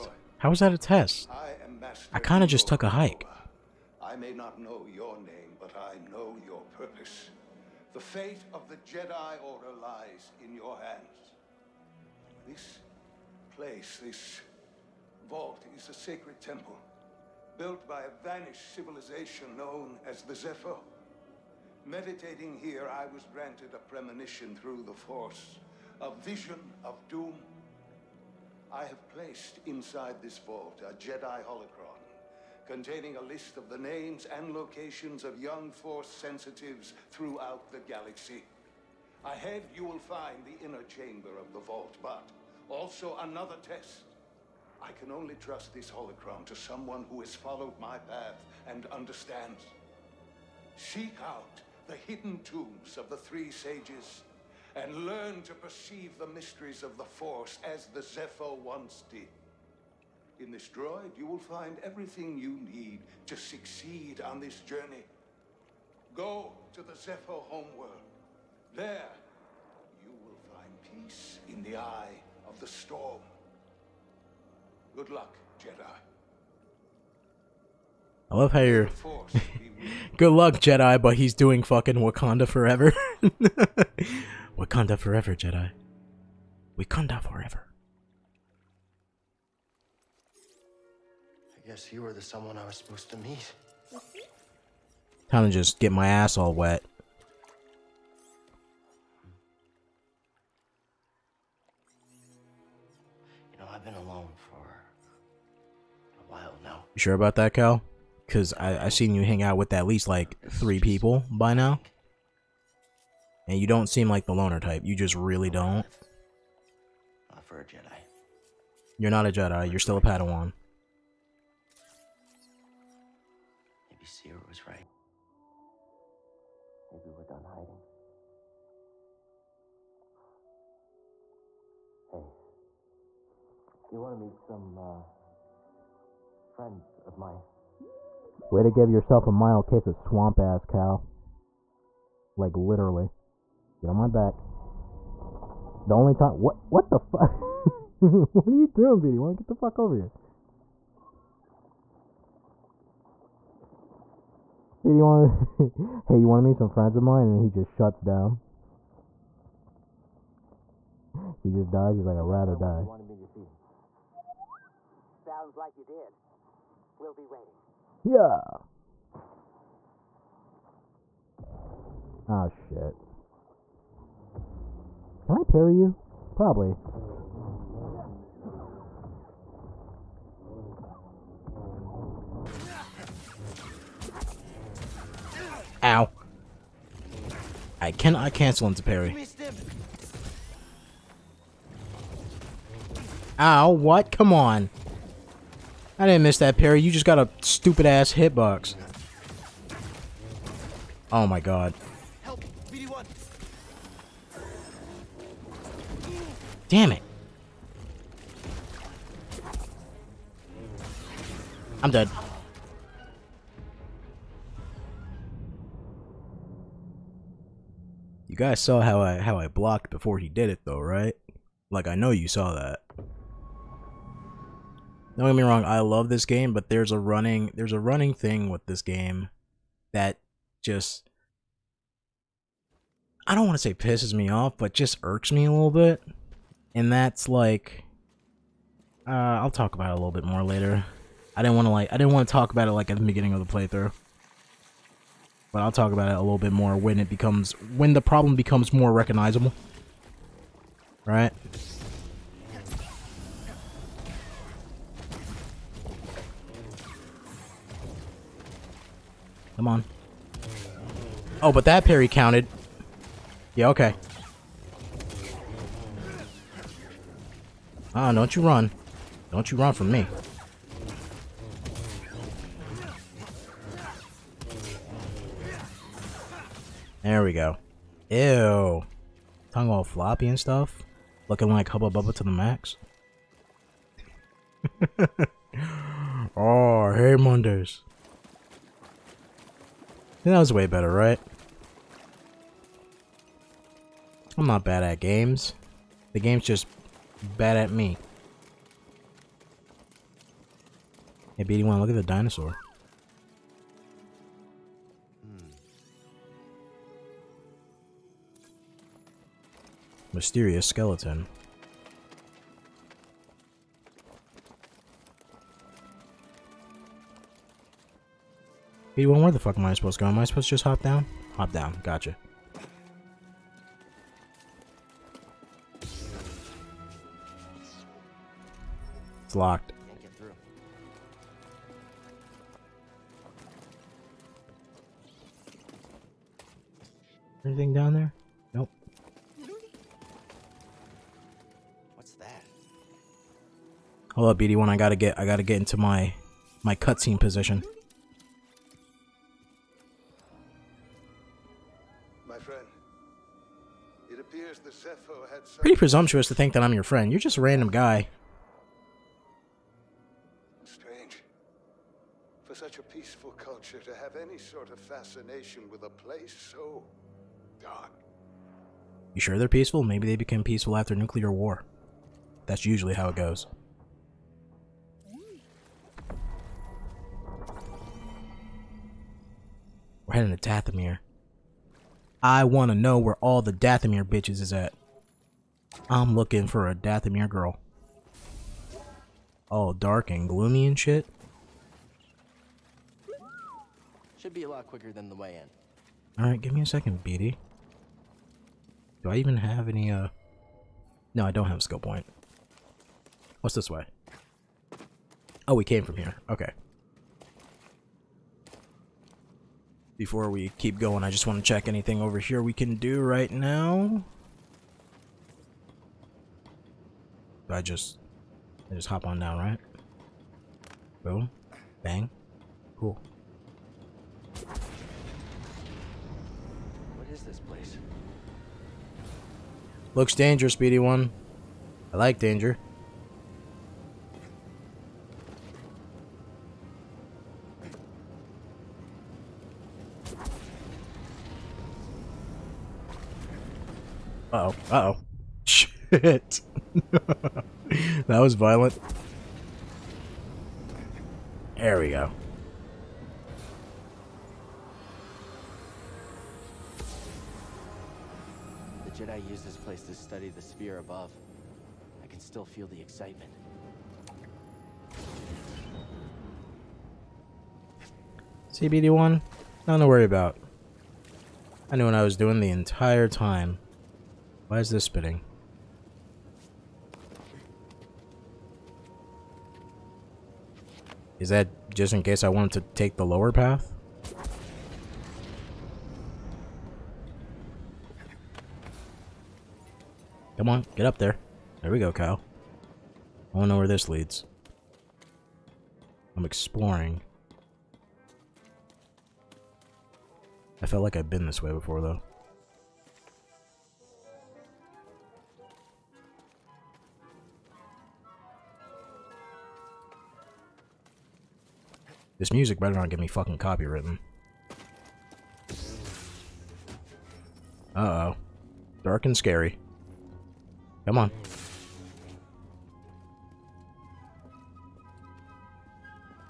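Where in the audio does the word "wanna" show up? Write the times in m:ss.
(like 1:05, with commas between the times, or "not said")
2:29, 2:36, 8:13.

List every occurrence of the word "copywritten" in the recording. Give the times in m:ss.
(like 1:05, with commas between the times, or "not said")
8:33.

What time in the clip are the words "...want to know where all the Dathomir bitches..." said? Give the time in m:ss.
6:22.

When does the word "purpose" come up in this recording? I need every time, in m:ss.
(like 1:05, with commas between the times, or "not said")
0:06.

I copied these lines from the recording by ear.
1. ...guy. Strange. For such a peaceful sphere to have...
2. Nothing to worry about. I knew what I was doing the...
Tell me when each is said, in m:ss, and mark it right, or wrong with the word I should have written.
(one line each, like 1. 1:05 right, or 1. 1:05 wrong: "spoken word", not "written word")
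1. 5:57 wrong: "culture", not "sphere"
2. 7:49 right.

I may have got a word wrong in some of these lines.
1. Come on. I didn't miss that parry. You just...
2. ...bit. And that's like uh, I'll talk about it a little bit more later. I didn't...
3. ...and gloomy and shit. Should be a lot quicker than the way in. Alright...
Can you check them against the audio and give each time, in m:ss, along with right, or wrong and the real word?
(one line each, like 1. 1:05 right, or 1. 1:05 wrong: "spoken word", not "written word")
1. 3:14 right
2. 3:55 right
3. 6:30 right.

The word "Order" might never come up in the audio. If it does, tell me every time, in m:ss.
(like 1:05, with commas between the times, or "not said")
0:09.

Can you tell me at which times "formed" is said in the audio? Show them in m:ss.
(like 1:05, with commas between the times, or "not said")
not said.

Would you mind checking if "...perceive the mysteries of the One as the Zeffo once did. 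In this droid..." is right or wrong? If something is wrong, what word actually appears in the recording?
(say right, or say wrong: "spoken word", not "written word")
wrong: "Force", not "One".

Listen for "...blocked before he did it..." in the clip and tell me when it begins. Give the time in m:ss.
3:39.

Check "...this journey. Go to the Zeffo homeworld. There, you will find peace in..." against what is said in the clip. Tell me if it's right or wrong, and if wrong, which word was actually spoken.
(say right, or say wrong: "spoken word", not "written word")
right.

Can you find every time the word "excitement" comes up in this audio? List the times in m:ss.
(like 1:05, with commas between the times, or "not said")
7:42.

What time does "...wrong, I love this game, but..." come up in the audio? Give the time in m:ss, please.
3:45.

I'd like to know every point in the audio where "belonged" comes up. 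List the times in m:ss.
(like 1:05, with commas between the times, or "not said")
not said.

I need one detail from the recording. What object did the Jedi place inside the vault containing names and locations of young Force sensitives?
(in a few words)
Jedi holocron.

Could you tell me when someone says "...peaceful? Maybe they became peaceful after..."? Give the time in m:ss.
6:09.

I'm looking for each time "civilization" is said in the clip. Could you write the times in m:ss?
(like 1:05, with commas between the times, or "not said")
0:18.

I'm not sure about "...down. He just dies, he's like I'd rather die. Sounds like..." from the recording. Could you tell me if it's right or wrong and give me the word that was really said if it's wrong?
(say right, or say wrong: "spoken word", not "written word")
right.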